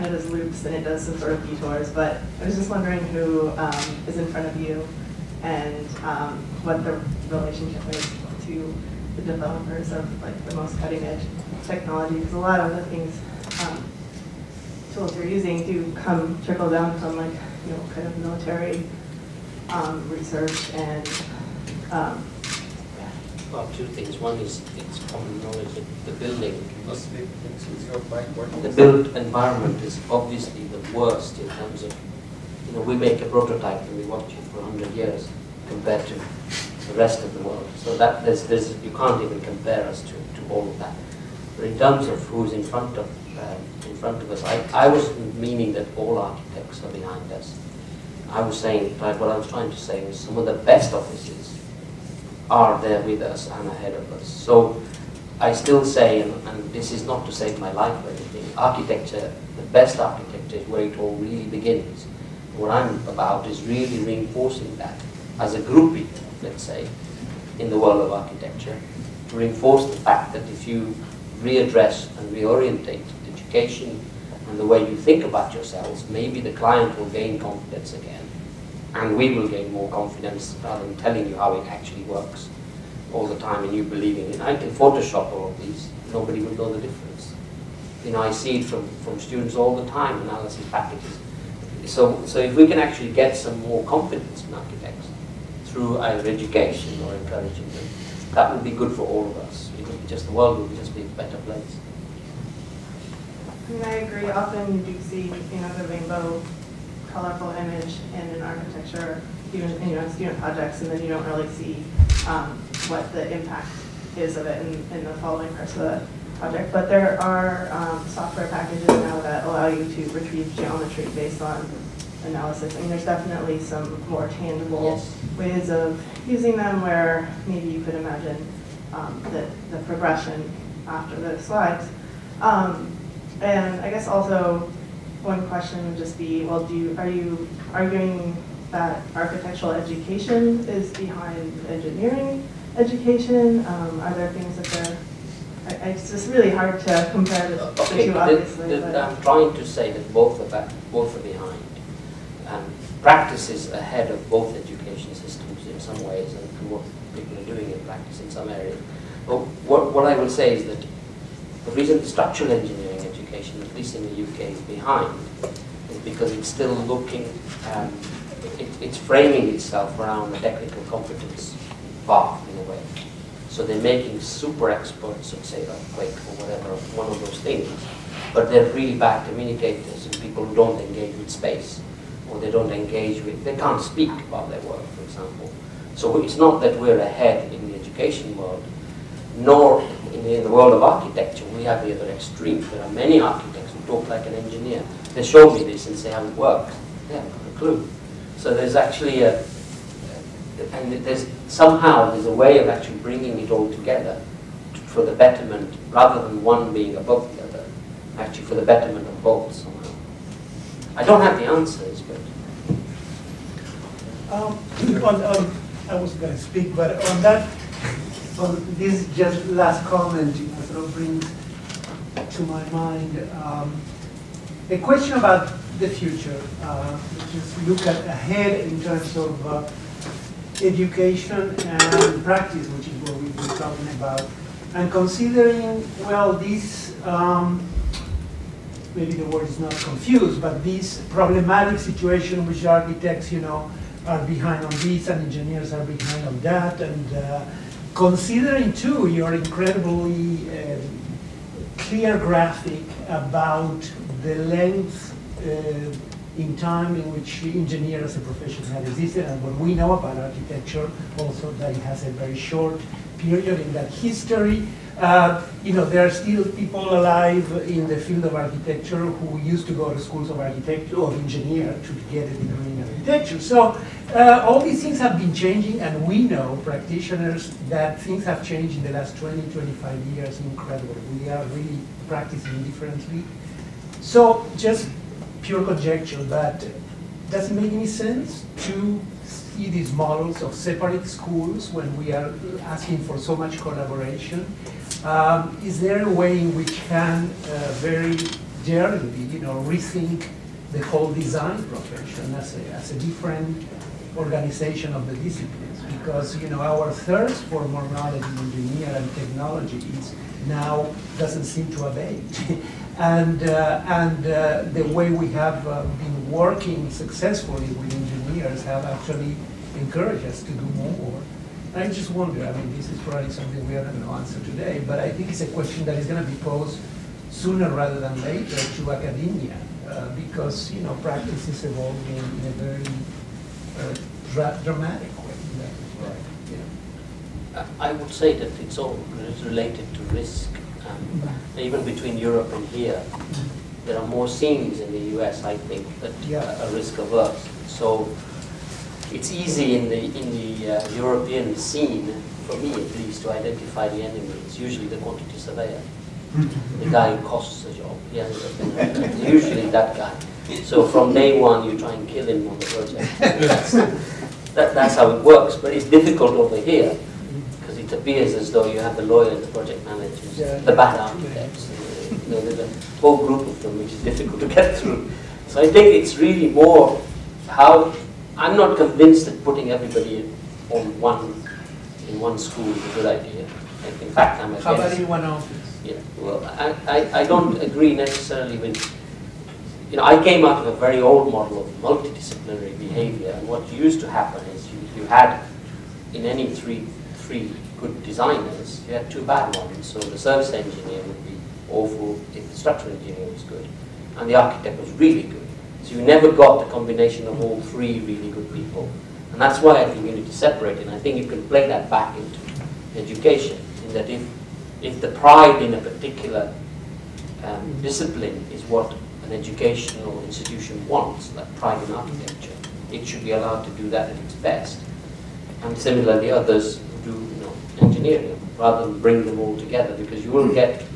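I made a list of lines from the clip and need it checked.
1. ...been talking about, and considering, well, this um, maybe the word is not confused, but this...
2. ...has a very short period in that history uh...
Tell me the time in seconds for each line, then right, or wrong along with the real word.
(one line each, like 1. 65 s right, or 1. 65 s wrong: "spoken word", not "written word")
1. 233 s right
2. 261 s right.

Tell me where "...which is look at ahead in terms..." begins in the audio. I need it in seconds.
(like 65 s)
227 s.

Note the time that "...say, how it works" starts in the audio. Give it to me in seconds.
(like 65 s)
195 s.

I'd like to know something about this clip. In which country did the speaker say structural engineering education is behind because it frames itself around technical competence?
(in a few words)
UK.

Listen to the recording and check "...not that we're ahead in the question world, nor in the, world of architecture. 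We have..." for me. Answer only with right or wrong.
wrong.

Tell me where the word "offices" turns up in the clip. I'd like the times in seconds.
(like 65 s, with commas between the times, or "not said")
50 s, 385 s.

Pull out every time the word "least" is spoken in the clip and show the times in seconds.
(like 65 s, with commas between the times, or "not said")
163 s, 352 s.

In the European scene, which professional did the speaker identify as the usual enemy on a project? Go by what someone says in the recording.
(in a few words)
quantity surveyor.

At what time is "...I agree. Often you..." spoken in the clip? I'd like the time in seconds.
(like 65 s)
103 s.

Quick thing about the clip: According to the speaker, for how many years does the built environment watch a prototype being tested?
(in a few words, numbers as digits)
100 years.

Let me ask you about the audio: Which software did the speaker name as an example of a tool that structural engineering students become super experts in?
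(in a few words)
Quake.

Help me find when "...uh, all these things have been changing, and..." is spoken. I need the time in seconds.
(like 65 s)
274 s.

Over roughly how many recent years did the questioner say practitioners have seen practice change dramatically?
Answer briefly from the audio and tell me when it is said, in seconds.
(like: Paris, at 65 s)
20 to 25 years, at 279 s.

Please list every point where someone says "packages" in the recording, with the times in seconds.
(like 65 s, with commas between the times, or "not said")
90 s, 118 s.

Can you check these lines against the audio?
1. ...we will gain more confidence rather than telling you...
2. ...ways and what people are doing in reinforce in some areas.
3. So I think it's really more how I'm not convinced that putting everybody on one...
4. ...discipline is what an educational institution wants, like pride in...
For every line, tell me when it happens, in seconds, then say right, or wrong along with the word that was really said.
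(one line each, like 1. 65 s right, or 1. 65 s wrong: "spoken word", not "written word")
1. 79 s right
2. 156 s wrong: "practice", not "reinforce"
3. 375 s right
4. 417 s right.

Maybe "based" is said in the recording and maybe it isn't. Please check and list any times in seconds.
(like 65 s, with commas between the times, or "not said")
121 s.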